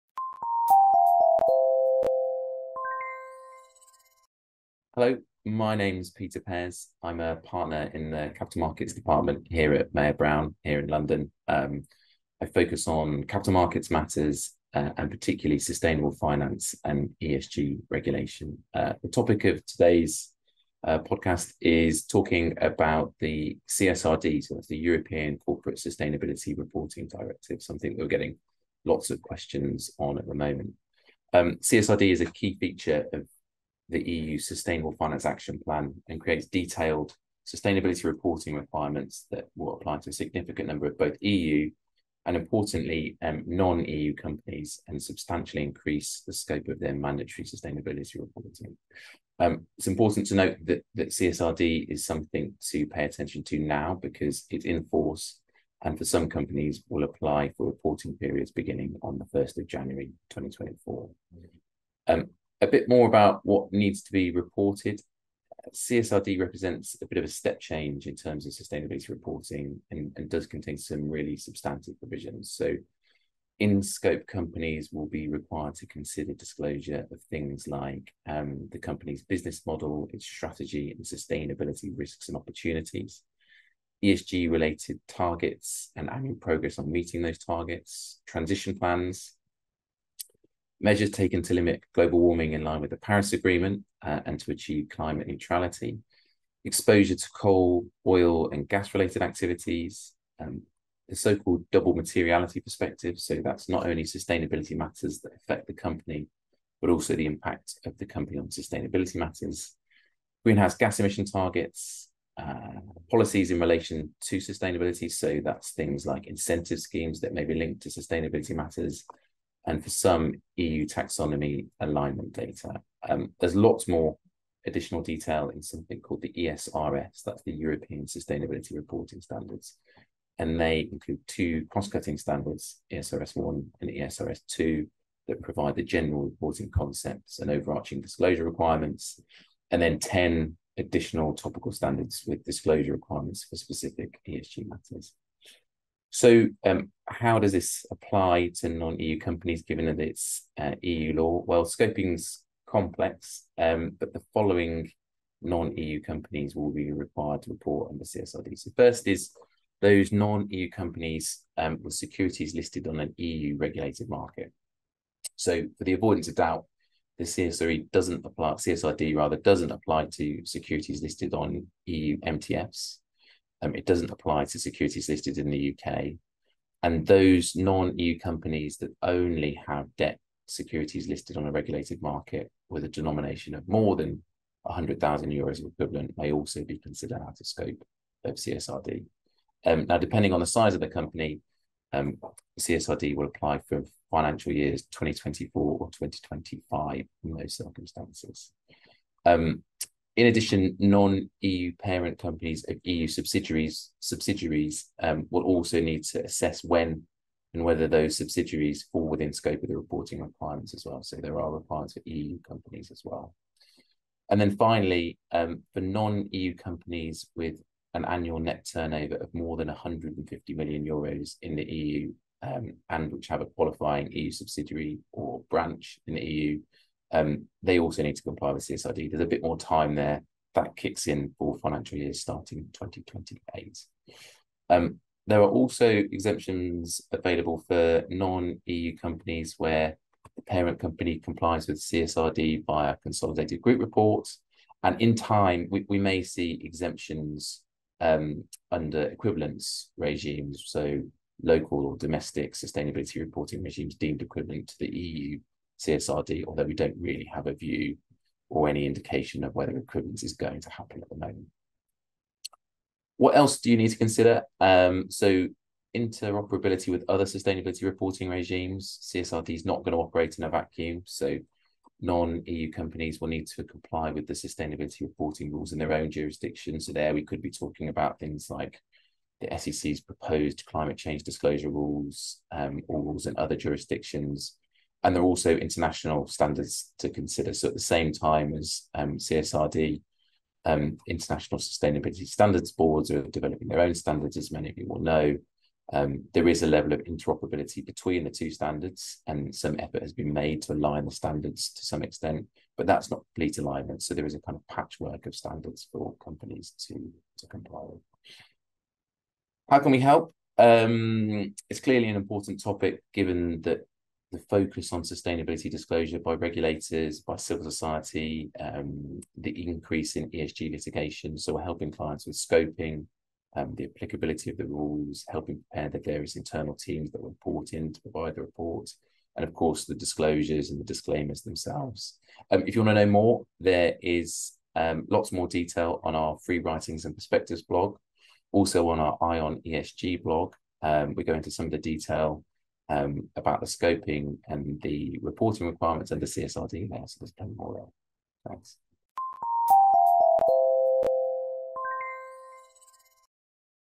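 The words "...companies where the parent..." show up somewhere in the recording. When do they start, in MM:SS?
03:58.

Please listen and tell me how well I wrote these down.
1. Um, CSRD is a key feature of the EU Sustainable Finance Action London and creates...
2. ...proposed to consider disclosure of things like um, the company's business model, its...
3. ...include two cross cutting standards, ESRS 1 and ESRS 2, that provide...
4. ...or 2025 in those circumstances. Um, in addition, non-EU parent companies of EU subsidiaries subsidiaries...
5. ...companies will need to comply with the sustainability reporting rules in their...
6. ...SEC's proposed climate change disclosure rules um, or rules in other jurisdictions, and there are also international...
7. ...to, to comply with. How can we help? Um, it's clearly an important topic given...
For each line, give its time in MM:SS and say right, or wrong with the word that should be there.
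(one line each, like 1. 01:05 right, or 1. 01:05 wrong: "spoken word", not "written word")
1. 00:31 wrong: "Plan", not "London"
2. 01:15 wrong: "required", not "proposed"
3. 02:10 right
4. 03:15 right
5. 04:32 right
6. 04:39 right
7. 05:06 right.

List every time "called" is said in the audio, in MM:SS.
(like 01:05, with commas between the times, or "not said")
01:41, 02:06.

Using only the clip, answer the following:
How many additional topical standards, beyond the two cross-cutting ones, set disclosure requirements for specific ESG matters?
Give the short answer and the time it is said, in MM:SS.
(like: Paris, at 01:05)
10, at 02:19.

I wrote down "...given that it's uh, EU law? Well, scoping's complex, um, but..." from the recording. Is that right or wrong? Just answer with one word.
right.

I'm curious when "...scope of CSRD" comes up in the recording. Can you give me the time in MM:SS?
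03:07.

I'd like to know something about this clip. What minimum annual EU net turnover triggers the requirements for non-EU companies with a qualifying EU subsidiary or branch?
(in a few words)
150 million euros.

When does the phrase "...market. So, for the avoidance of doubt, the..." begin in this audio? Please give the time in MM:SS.
02:44.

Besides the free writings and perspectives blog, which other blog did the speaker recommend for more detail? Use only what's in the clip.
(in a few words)
Eye on ESG.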